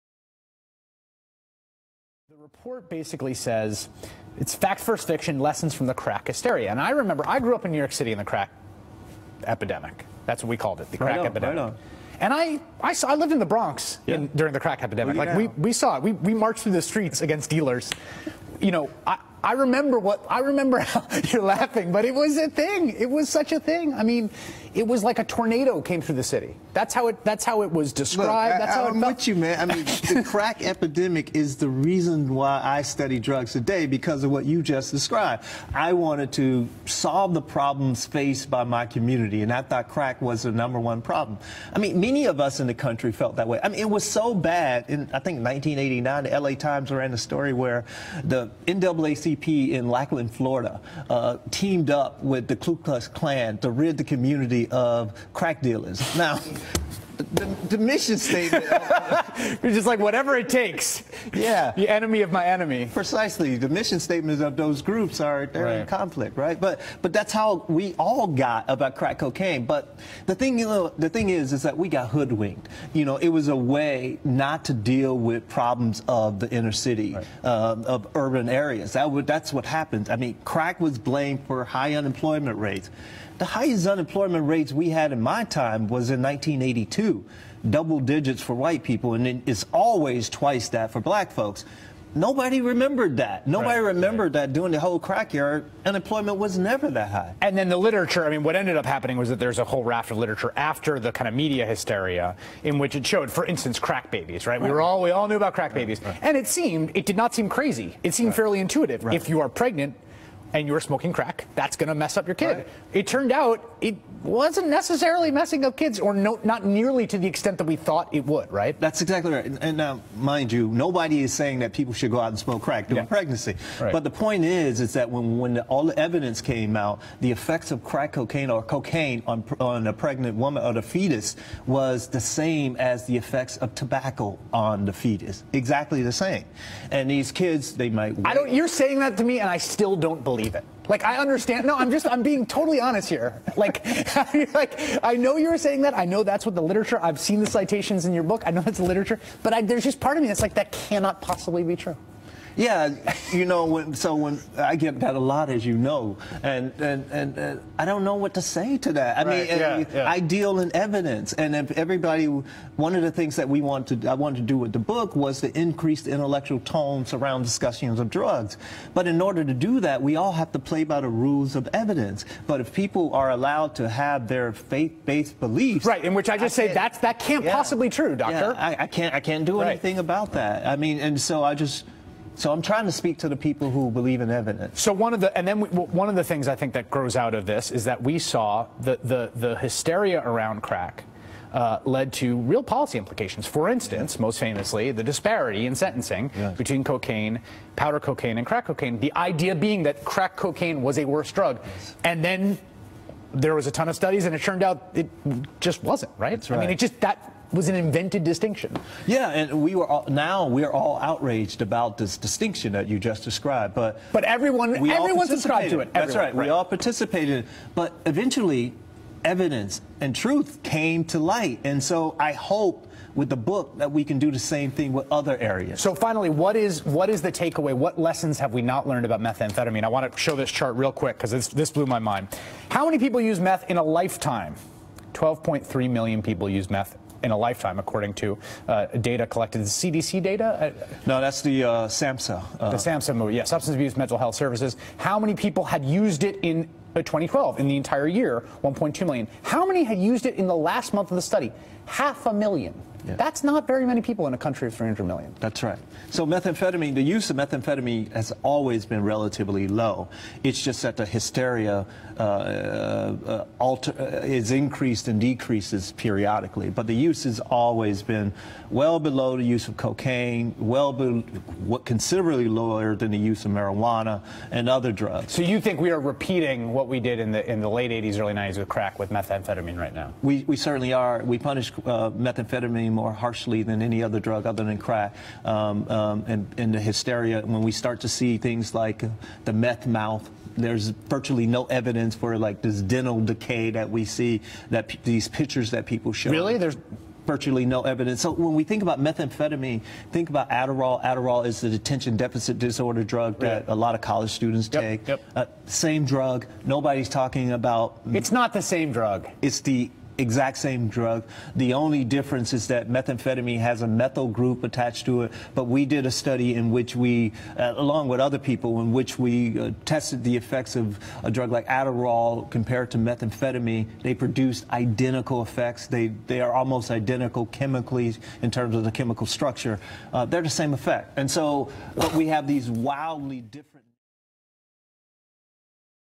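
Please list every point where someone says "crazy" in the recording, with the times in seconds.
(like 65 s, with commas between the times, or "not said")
107 s.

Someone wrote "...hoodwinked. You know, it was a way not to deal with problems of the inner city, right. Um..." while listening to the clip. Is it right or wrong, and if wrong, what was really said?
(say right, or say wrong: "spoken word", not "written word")
right.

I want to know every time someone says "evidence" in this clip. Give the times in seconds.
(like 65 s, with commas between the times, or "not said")
125 s, 160 s, 171 s, 184 s, 219 s, 291 s, 297 s.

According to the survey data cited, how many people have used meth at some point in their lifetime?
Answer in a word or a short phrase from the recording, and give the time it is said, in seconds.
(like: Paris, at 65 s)
12.3 million, at 235 s.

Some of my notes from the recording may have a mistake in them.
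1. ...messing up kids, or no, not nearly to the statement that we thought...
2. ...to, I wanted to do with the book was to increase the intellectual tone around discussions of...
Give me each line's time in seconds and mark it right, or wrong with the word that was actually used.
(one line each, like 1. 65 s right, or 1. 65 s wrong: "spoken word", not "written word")
1. 115 s wrong: "extent", not "statement"
2. 163 s right.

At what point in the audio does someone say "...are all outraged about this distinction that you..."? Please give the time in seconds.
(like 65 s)
210 s.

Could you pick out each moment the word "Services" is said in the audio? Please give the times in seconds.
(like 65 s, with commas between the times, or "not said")
244 s.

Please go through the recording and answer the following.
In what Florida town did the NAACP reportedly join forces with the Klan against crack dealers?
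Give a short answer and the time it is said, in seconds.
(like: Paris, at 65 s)
Lakeland, at 49 s.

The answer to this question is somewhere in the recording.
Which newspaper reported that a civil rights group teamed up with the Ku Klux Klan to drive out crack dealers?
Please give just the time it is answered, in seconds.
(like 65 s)
46 s.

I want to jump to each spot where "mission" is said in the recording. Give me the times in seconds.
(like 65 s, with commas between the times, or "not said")
57 s, 63 s.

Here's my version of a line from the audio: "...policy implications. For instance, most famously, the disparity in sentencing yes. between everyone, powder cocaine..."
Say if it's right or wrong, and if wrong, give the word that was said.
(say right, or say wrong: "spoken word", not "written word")
wrong: "cocaine", not "everyone".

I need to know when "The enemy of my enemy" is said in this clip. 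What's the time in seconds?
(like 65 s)
61 s.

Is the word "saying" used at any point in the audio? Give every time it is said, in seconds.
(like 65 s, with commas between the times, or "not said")
121 s, 138 s, 145 s.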